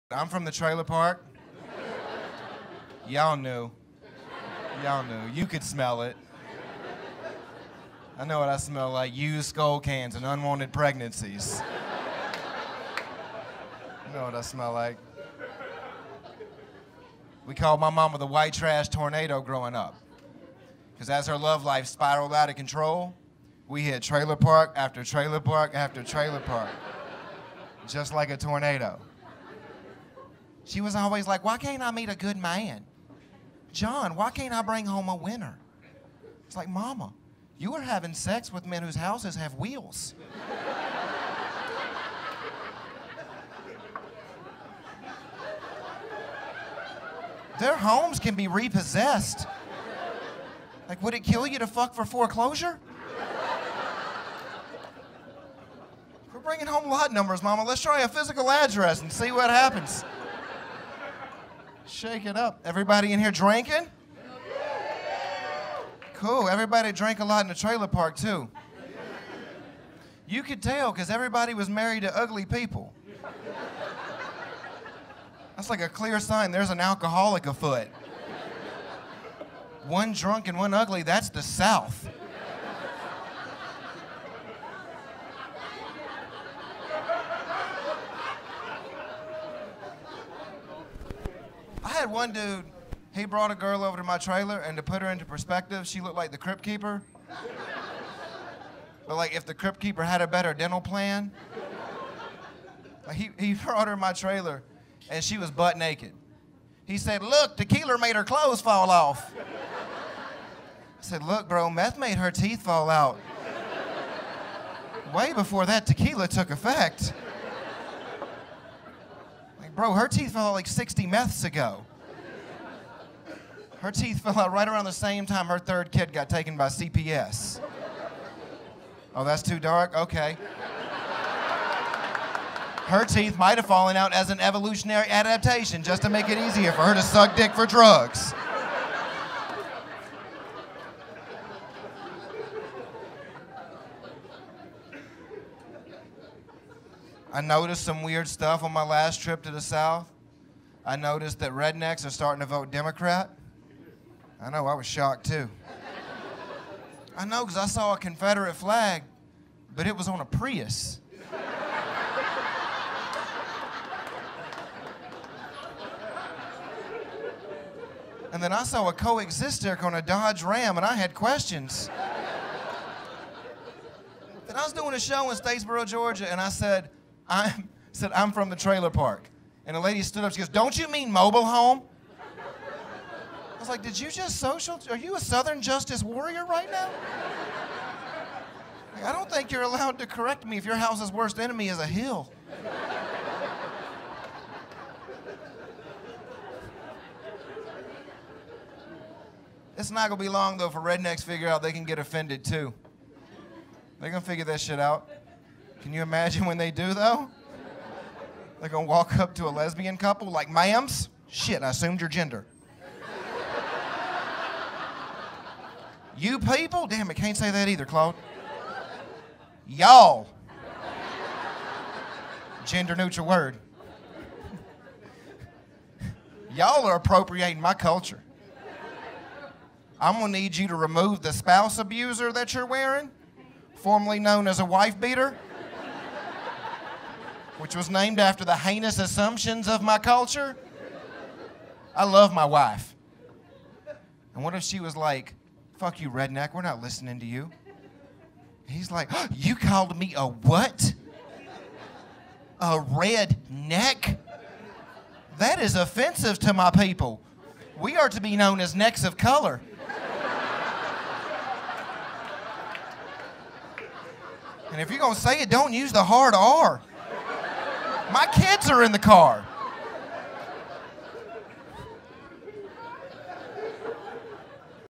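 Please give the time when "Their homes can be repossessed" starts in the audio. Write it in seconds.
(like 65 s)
47 s.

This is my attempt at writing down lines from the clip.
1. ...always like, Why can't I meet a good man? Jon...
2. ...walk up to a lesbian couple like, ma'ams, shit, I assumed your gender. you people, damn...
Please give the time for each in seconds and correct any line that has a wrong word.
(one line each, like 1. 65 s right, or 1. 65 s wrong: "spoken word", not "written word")
1. 30 s right
2. 208 s right.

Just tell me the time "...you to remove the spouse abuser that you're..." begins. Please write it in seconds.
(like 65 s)
230 s.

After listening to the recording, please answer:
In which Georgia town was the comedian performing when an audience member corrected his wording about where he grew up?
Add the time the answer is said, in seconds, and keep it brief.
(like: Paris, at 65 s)
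Statesboro, at 175 s.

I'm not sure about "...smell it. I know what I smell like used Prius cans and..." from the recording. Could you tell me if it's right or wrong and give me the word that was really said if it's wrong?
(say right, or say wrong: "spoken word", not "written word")
wrong: "Skoal", not "Prius".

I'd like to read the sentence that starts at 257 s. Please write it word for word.
We are to be known as necks of color.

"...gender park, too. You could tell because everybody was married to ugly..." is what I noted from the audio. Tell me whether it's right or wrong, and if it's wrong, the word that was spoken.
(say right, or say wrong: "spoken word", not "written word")
wrong: "trailer", not "gender".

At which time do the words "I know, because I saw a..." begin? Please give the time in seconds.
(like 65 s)
157 s.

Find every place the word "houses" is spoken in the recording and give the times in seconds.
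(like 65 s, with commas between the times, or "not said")
38 s, 190 s.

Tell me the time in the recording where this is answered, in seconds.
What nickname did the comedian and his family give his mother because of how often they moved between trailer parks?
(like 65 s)
18 s.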